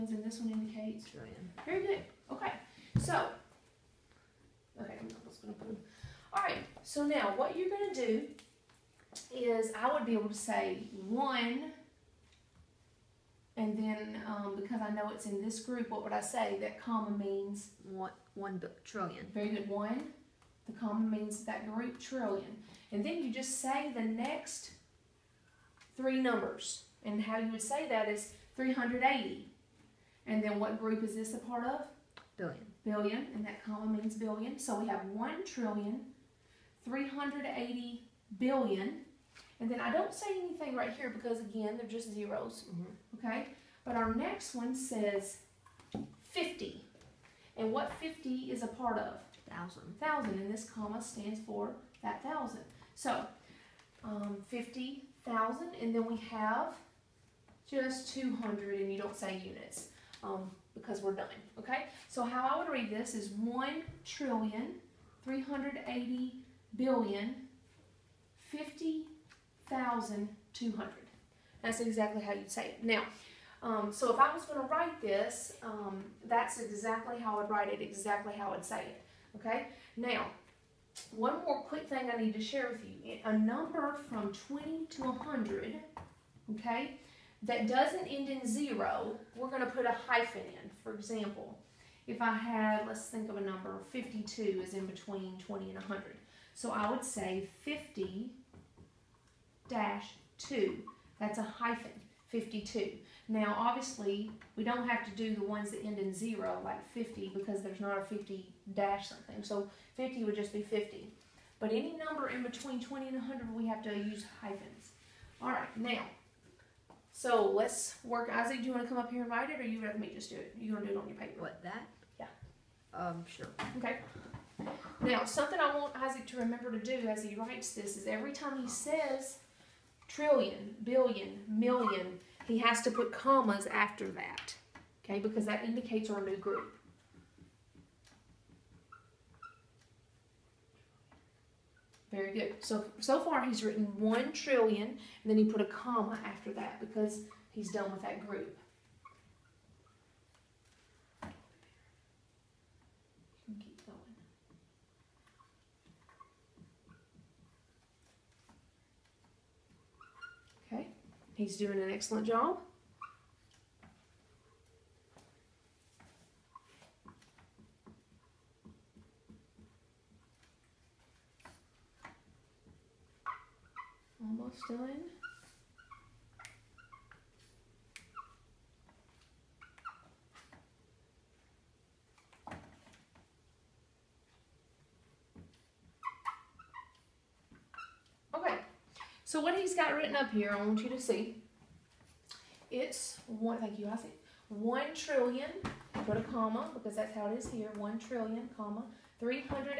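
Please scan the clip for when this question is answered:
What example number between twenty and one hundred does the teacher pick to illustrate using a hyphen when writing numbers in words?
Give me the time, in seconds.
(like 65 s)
93 s.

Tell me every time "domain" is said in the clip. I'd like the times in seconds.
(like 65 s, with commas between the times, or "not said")
not said.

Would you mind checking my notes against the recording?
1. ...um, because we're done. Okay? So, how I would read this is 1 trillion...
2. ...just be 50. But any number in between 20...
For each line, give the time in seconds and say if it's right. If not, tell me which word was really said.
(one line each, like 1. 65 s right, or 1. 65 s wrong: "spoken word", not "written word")
1. 60 s right
2. 110 s right.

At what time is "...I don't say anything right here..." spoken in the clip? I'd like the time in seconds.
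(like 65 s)
39 s.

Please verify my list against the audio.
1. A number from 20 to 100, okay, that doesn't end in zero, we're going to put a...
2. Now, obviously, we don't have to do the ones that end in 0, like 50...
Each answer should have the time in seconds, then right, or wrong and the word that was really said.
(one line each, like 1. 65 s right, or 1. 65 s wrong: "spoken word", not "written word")
1. 83 s right
2. 103 s right.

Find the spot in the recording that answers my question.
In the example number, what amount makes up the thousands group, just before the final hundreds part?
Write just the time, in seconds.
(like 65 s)
43 s.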